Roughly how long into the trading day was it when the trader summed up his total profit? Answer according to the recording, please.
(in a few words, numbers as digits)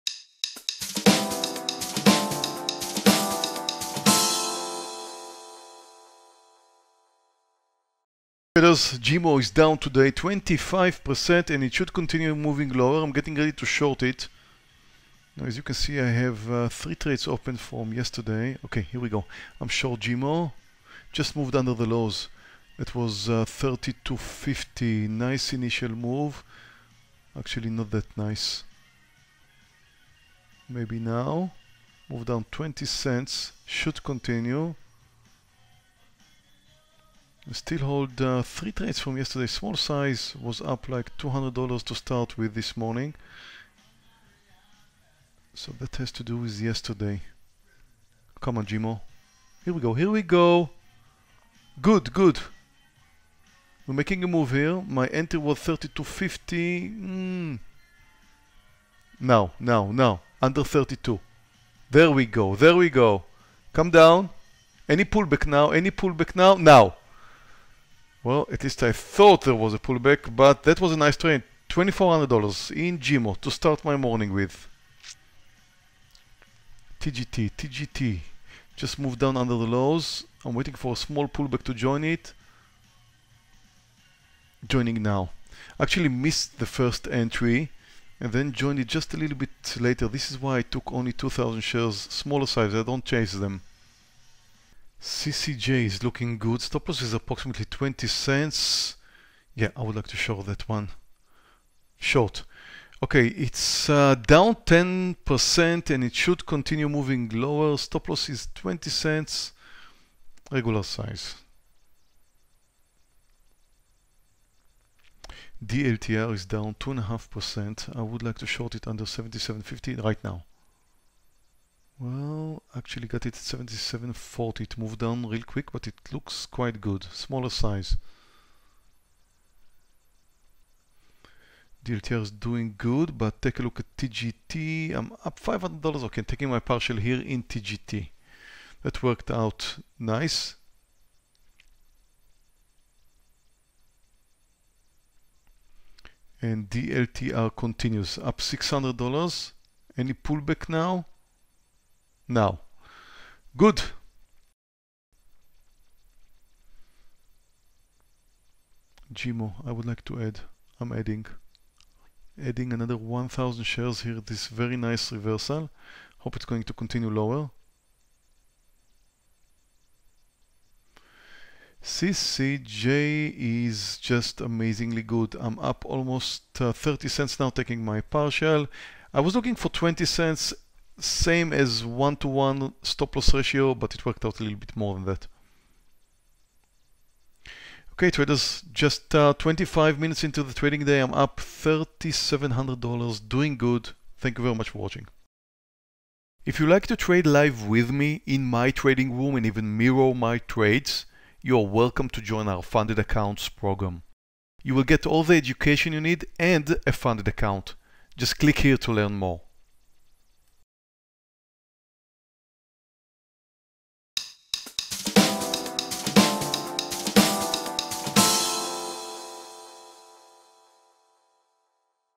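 25 minutes.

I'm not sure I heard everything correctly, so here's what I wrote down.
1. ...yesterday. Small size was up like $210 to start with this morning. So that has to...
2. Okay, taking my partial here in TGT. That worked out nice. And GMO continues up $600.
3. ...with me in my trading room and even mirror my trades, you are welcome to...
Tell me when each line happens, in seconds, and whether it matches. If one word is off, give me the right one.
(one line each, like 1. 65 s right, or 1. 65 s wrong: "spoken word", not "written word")
1. 39 s wrong: "200", not "210"
2. 136 s wrong: "DLTR", not "GMO"
3. 197 s right.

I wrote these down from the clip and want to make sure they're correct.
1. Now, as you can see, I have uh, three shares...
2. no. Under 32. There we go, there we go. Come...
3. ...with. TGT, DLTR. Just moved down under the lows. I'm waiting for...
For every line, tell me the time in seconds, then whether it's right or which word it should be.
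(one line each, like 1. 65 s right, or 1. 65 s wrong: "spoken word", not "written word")
1. 15 s wrong: "trades", not "shares"
2. 59 s right
3. 74 s wrong: "TGT", not "DLTR".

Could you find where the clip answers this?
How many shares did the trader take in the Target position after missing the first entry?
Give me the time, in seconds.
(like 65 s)
91 s.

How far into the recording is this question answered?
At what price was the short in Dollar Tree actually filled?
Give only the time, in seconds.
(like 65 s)
123 s.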